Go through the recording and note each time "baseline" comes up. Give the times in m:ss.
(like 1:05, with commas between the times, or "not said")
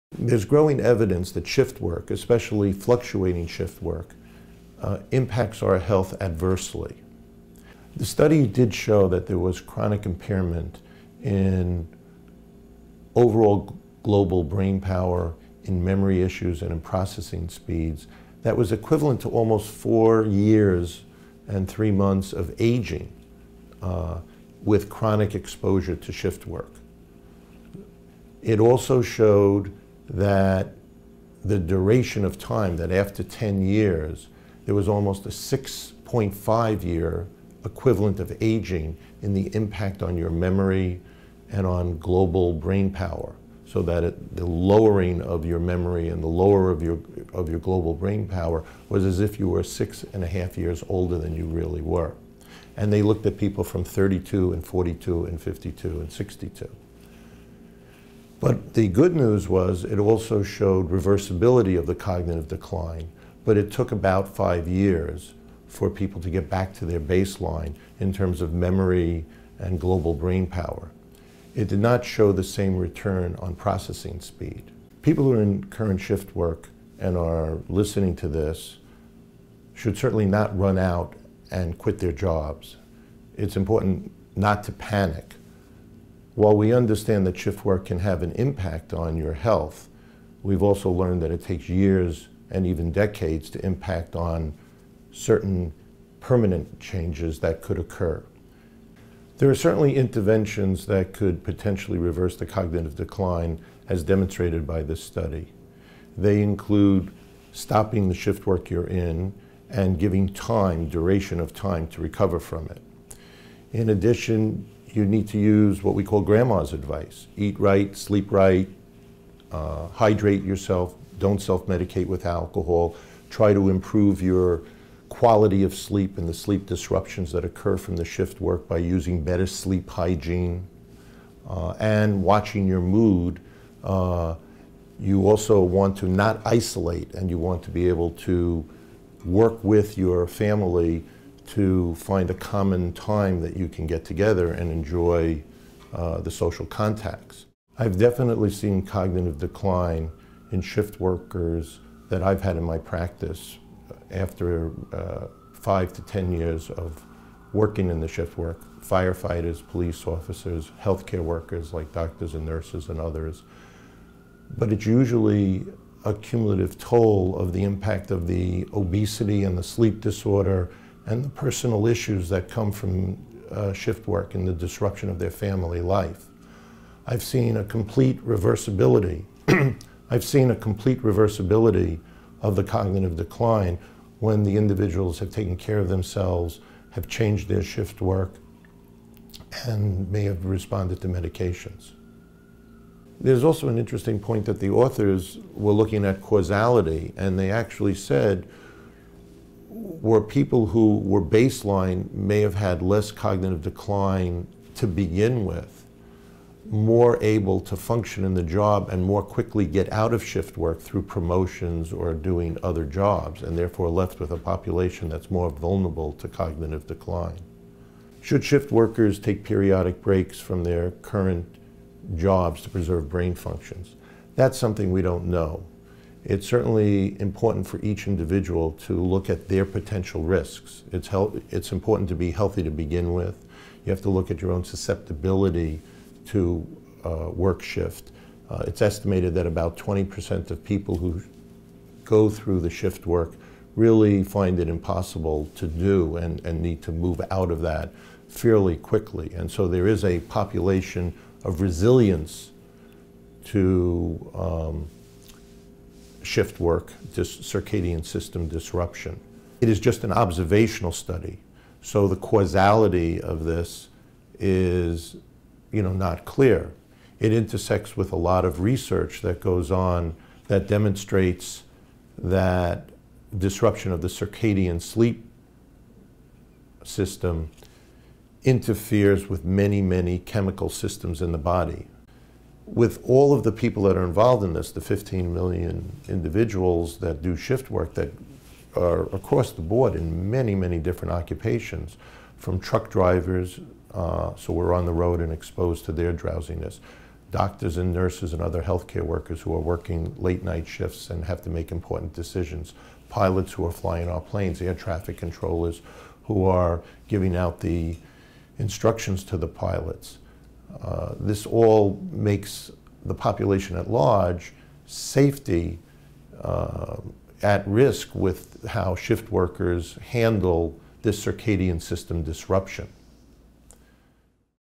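1:06, 3:21.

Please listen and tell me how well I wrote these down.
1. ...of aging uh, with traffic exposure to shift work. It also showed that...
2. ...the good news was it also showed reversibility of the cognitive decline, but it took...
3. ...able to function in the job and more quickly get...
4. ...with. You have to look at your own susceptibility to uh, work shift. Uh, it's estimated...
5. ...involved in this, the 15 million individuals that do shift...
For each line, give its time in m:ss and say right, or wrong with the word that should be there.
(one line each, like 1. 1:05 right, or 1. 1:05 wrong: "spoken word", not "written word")
1. 0:22 wrong: "chronic", not "traffic"
2. 0:58 right
3. 3:27 right
4. 3:53 right
5. 4:44 right.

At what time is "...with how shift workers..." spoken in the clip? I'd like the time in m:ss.
5:18.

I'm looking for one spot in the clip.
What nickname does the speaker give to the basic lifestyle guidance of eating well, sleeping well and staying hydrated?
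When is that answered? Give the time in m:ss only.
1:56.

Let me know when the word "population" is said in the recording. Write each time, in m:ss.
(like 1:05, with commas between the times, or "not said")
3:34, 4:10, 5:13.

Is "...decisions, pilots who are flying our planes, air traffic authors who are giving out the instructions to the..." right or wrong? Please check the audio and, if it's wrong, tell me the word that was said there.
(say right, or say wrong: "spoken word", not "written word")
wrong: "controllers", not "authors".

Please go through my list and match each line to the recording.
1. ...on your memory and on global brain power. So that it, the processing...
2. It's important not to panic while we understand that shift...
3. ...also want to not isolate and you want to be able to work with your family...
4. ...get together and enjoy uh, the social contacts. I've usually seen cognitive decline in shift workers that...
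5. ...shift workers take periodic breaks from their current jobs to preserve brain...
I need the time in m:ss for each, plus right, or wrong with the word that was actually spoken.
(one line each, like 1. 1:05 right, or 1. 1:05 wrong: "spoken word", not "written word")
1. 0:40 wrong: "lowering", not "processing"
2. 1:23 right
3. 2:15 right
4. 2:23 wrong: "definitely", not "usually"
5. 3:38 right.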